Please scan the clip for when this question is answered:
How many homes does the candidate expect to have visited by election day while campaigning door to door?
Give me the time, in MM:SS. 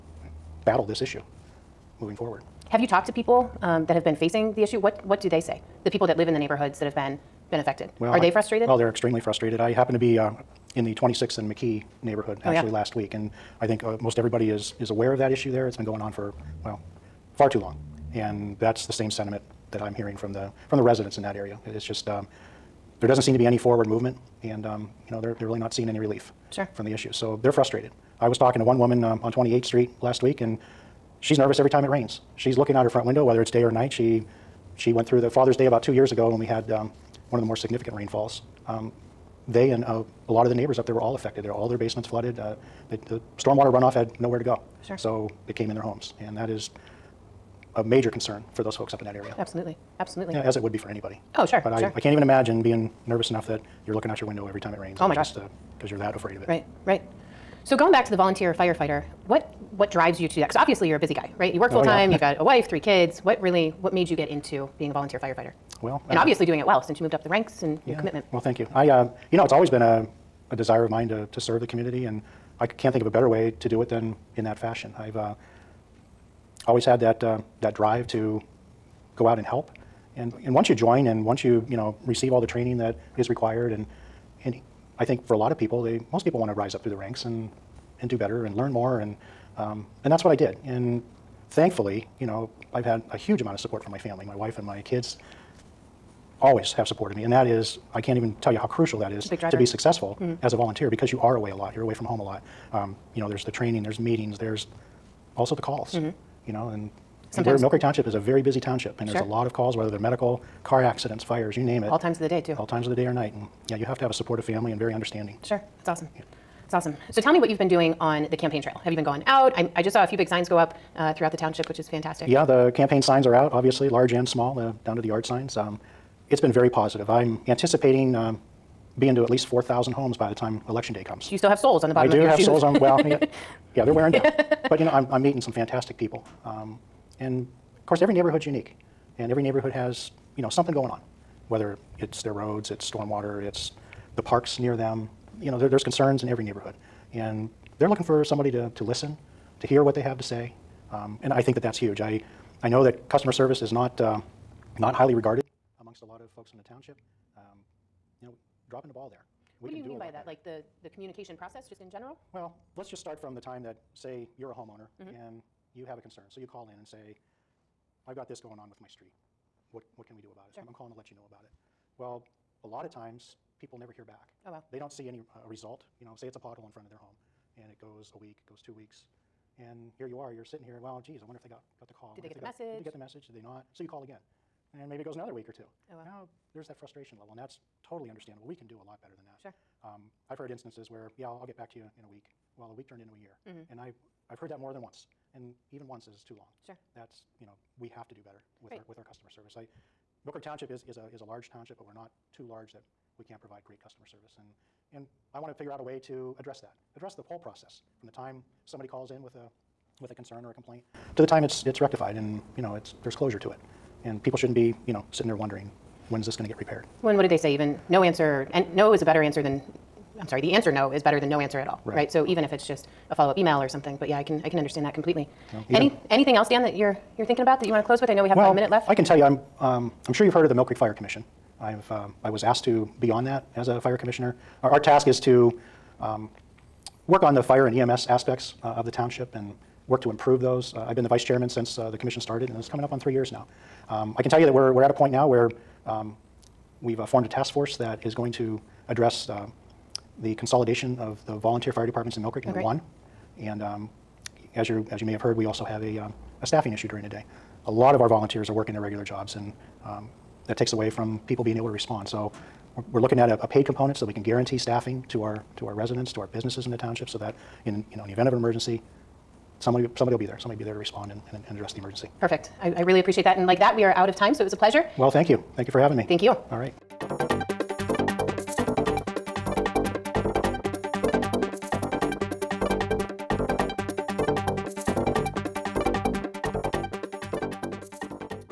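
02:09.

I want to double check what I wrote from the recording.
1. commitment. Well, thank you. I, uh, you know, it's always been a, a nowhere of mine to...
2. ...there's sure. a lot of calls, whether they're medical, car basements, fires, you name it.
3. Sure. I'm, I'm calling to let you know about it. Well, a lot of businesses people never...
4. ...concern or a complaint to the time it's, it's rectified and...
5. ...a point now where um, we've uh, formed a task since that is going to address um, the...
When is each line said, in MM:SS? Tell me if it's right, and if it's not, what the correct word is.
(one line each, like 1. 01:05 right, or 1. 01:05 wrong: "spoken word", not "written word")
1. 01:08 wrong: "desire", not "nowhere"
2. 01:49 wrong: "accidents", not "basements"
3. 02:50 wrong: "times", not "businesses"
4. 03:30 right
5. 04:04 wrong: "force", not "since".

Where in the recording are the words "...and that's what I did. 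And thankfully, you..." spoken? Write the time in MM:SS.
01:30.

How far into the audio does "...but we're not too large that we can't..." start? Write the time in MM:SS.
03:21.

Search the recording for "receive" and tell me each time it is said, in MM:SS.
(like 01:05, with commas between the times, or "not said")
01:22.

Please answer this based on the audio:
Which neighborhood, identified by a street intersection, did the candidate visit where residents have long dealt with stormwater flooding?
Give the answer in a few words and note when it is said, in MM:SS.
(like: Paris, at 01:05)
26th and McKee, at 00:10.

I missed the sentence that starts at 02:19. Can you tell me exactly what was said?
And every neighborhood has, you know, something going on, whether it's their roads, it's stormwater, it's the parks near them.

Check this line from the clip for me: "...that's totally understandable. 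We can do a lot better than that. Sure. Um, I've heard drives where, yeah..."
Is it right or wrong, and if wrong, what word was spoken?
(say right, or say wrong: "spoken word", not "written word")
wrong: "instances", not "drives".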